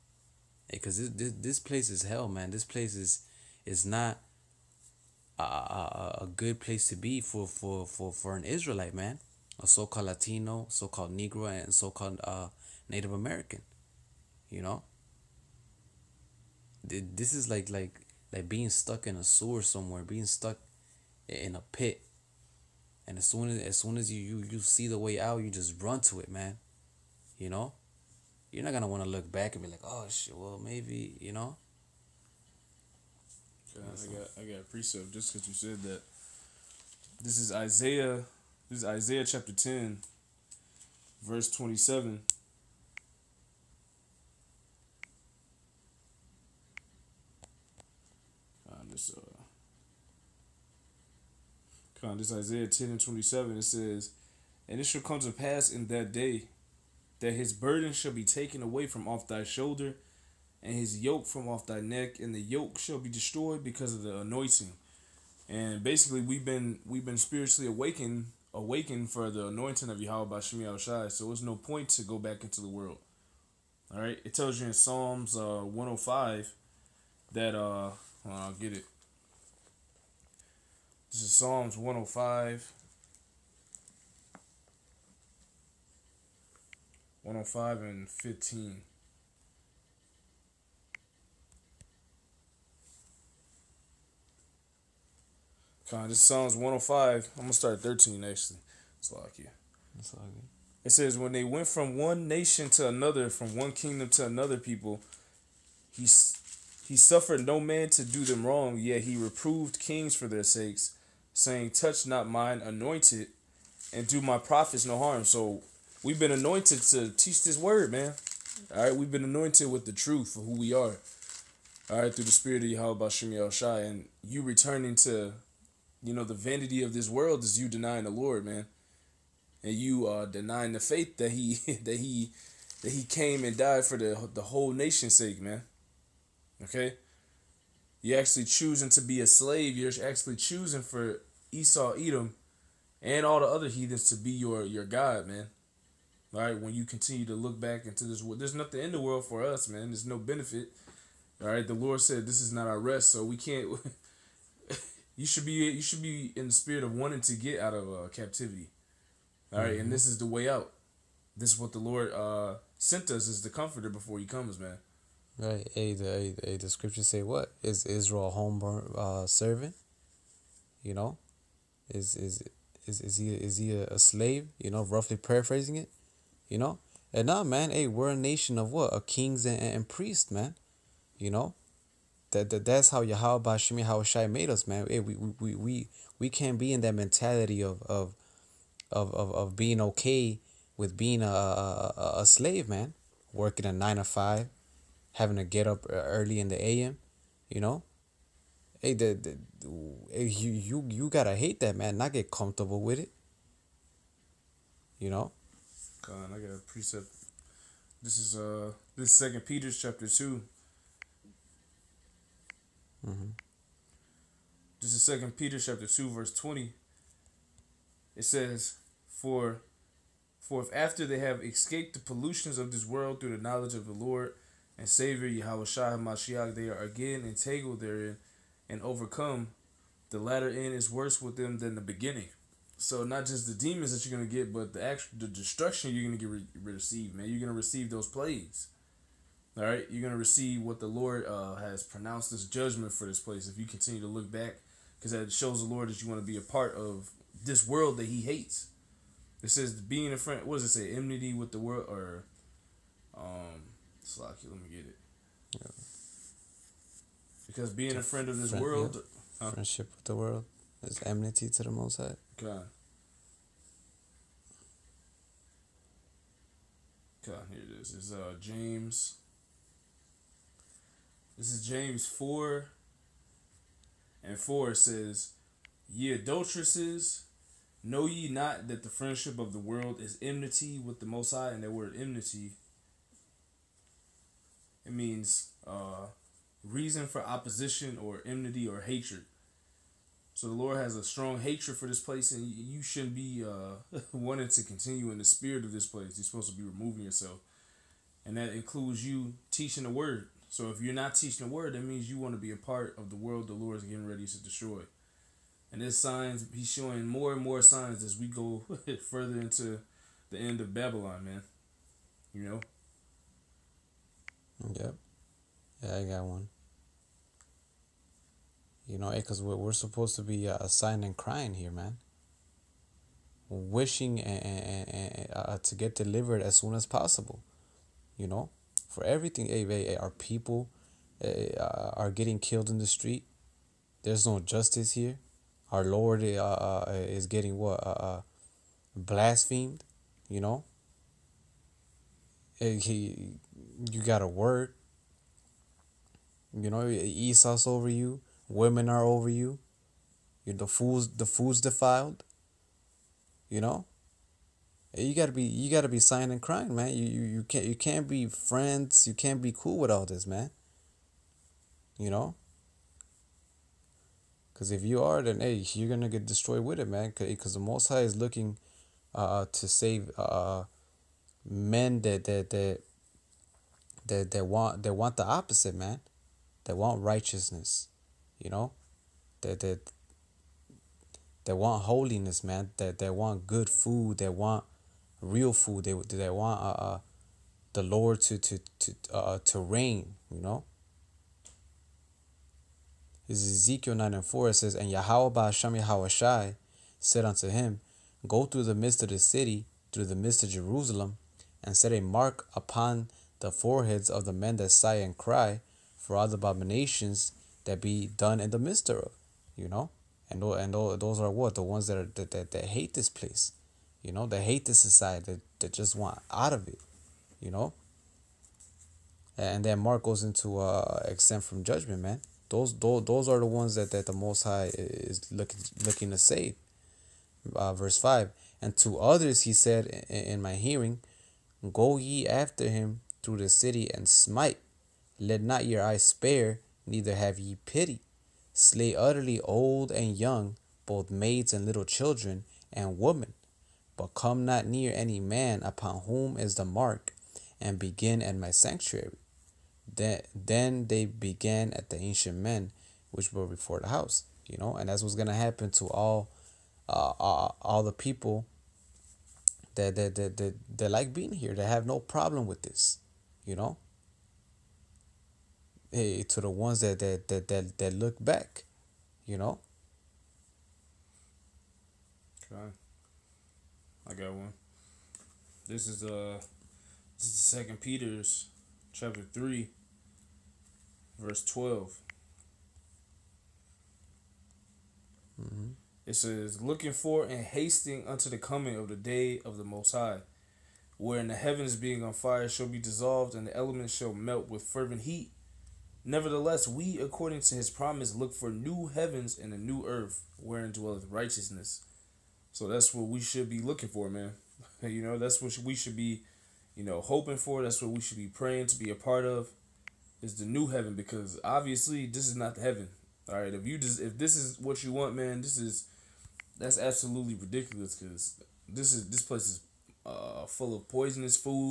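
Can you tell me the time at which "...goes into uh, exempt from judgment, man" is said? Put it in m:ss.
7:00.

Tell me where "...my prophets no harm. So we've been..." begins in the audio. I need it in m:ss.
1:54.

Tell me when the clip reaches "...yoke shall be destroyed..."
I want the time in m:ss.
1:02.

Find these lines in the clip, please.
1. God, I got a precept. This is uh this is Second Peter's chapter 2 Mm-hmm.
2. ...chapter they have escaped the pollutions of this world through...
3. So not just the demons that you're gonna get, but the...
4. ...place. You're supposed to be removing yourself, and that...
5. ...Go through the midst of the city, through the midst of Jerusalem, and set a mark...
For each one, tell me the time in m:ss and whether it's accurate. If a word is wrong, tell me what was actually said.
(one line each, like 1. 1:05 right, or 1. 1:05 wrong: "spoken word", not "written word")
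1. 3:26 right
2. 3:40 wrong: "after", not "chapter"
3. 3:52 right
4. 4:55 right
5. 6:38 right.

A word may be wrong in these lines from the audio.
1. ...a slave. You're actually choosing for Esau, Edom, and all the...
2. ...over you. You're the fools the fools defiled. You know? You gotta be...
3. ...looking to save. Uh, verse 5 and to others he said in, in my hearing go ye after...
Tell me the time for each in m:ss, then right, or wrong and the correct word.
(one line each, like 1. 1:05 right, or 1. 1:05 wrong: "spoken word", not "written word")
1. 2:19 right
2. 5:49 right
3. 7:05 right.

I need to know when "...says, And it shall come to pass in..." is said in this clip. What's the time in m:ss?
0:53.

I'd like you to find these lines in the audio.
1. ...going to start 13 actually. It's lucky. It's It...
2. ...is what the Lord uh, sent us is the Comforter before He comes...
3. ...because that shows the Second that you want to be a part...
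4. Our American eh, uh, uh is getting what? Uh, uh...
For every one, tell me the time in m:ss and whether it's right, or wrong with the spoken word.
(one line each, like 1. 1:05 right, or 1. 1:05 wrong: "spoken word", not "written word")
1. 1:37 right
2. 2:41 right
3. 4:04 wrong: "Lord", not "Second"
4. 5:35 wrong: "Lord", not "American".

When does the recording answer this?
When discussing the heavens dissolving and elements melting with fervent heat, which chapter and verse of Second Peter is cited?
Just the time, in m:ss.
7:58.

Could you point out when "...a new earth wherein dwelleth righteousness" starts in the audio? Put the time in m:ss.
8:19.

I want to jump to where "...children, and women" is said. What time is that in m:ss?
7:21.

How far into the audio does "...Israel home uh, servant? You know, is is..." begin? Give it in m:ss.
2:47.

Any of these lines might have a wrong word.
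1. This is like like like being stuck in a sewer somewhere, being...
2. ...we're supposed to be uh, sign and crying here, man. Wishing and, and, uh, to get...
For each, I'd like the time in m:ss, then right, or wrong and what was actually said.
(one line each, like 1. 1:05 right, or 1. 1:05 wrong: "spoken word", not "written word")
1. 0:16 right
2. 5:19 right.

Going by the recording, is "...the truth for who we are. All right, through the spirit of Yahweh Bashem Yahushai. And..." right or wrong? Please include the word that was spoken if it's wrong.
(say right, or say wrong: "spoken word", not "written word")
right.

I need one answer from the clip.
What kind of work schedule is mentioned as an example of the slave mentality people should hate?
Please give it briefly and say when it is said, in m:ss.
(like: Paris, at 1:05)
nine to five, at 3:13.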